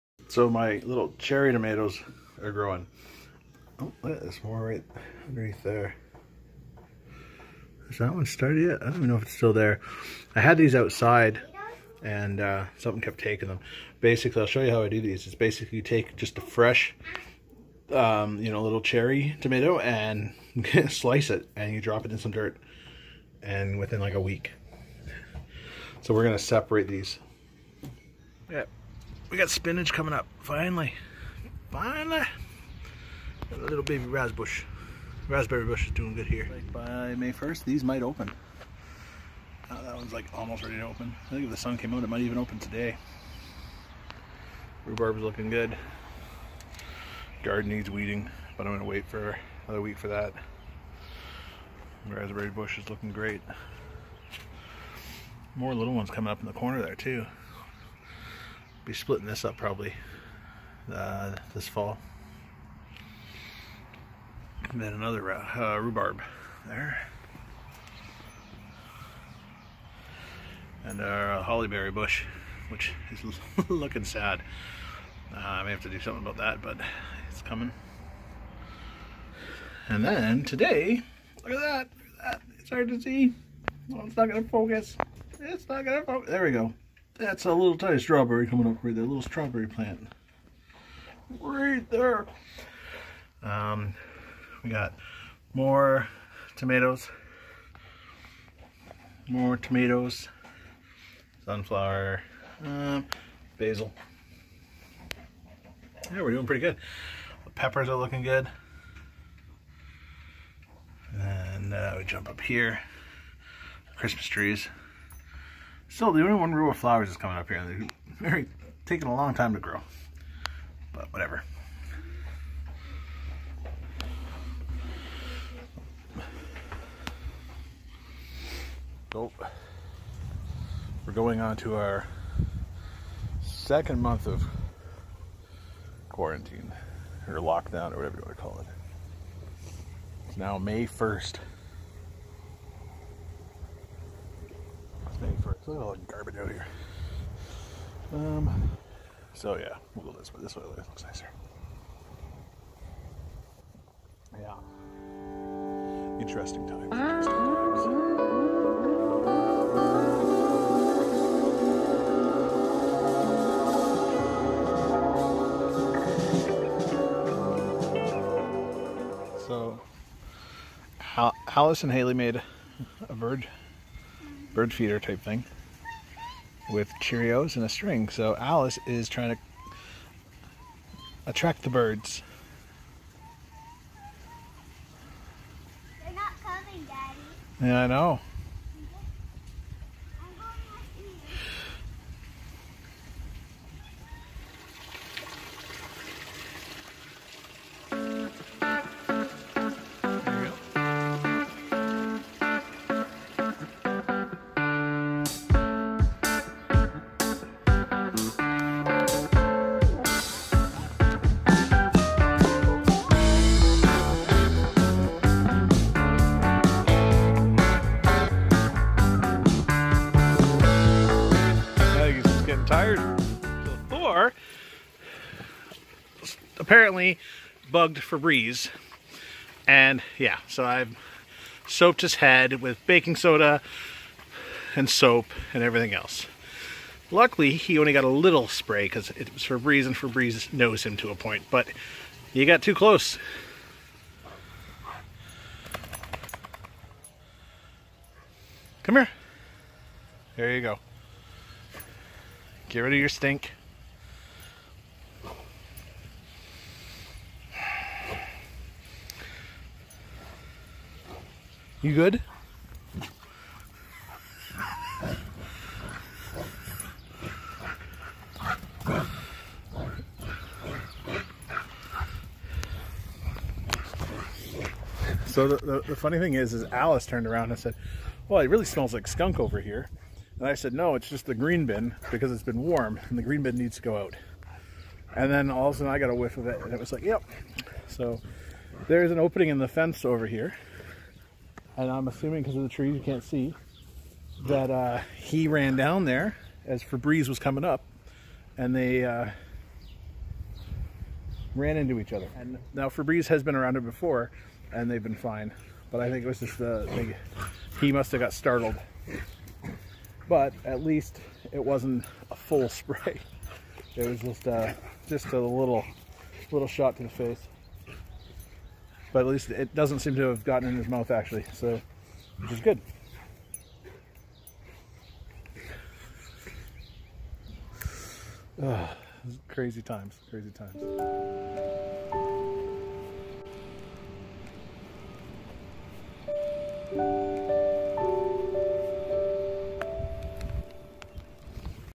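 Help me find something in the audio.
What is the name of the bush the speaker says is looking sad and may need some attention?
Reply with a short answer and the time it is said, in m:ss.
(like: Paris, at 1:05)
hollyberry bush, at 1:11.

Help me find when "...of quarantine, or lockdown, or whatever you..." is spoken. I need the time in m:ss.
2:14.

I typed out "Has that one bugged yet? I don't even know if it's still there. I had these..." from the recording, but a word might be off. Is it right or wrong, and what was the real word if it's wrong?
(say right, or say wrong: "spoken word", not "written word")
wrong: "started", not "bugged".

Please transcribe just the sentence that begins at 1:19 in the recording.
And then today, look at that, look at that.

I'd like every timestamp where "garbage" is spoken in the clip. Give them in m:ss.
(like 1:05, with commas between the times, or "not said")
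2:26.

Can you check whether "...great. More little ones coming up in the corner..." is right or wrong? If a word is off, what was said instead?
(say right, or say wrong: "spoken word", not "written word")
right.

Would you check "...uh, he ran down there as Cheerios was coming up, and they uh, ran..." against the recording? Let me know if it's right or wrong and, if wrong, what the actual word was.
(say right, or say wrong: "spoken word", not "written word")
wrong: "Febreze", not "Cheerios".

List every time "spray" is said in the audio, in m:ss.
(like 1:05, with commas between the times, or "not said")
3:58, 5:12.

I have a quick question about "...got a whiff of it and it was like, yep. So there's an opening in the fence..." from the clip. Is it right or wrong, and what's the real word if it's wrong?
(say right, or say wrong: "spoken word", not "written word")
right.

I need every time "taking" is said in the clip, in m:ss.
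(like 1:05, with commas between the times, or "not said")
0:13, 1:58.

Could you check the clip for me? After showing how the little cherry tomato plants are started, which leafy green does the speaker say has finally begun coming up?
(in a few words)
spinach.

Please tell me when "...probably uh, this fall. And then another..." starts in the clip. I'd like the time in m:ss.
0:59.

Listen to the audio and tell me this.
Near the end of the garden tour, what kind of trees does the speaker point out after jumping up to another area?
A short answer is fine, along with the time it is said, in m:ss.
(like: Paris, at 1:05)
Christmas trees, at 1:53.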